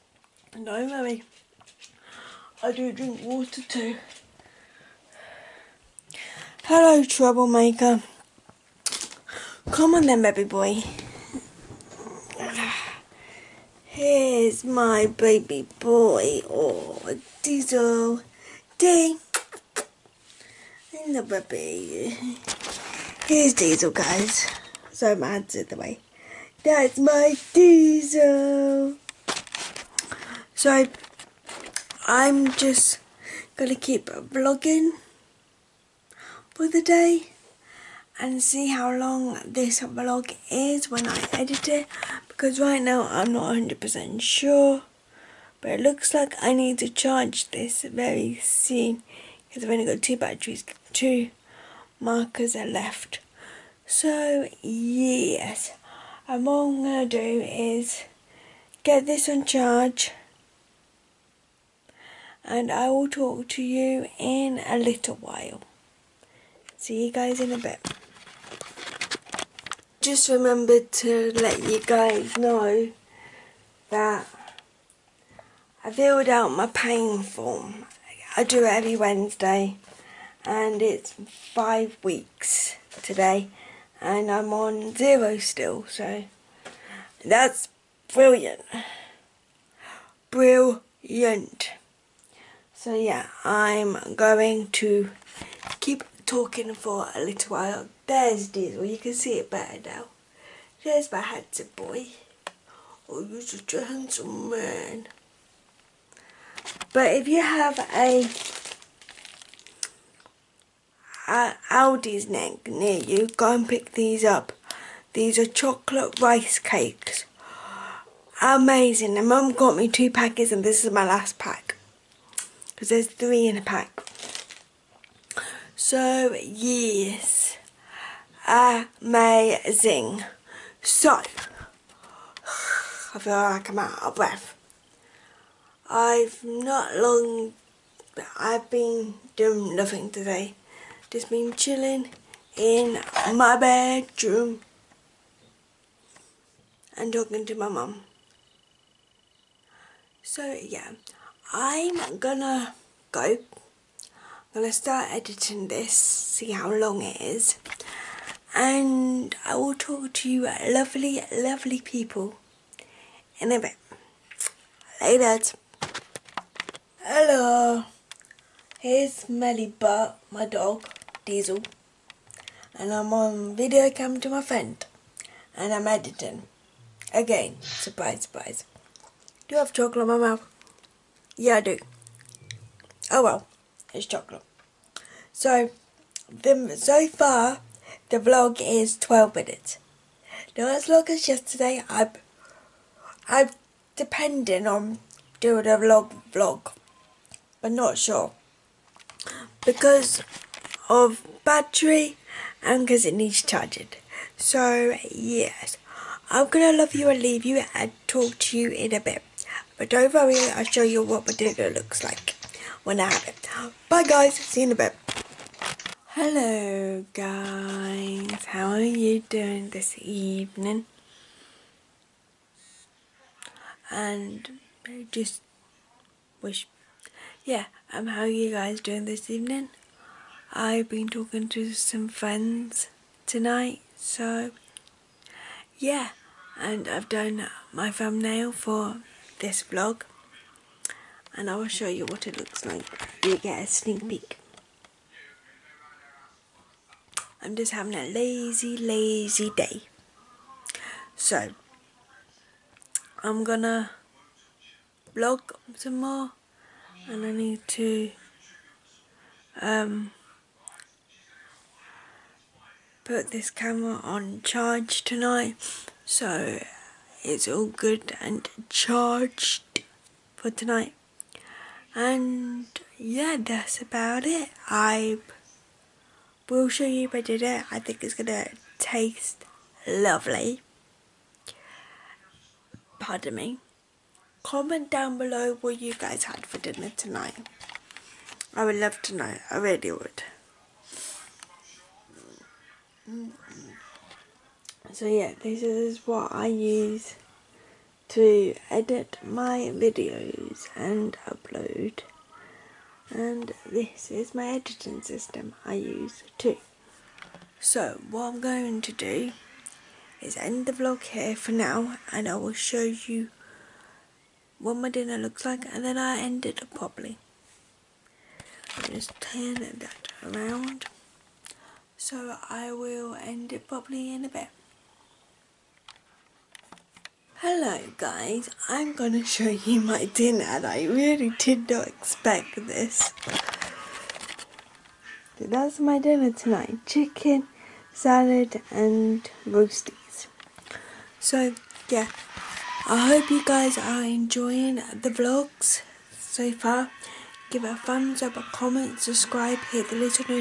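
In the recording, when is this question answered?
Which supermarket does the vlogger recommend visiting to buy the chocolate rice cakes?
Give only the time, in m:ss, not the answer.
1:51.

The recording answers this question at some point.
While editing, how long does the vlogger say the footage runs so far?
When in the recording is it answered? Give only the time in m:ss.
3:08.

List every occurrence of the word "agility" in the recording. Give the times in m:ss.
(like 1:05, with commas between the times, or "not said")
not said.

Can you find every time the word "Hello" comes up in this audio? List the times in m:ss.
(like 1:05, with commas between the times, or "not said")
0:06, 2:47, 3:36, 5:27.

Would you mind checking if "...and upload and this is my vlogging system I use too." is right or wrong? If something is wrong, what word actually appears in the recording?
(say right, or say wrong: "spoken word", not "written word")
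wrong: "editing", not "vlogging".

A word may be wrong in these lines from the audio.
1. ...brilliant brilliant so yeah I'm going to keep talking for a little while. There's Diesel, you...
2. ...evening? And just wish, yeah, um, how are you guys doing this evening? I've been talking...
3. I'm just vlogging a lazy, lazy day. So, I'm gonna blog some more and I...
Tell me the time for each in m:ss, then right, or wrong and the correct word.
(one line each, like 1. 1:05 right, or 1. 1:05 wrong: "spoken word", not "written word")
1. 1:28 right
2. 3:40 right
3. 4:07 wrong: "having", not "vlogging".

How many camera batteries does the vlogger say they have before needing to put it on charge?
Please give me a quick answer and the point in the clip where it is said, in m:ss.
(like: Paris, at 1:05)
2, at 0:50.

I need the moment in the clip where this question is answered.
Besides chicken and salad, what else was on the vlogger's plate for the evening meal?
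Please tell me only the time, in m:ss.
5:39.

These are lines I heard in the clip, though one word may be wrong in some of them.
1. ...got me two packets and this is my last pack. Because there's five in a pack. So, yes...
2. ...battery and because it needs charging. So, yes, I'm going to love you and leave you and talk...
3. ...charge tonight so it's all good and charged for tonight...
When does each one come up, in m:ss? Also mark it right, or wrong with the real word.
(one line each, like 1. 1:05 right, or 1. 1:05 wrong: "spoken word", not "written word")
1. 1:59 wrong: "three", not "five"
2. 3:21 right
3. 4:24 right.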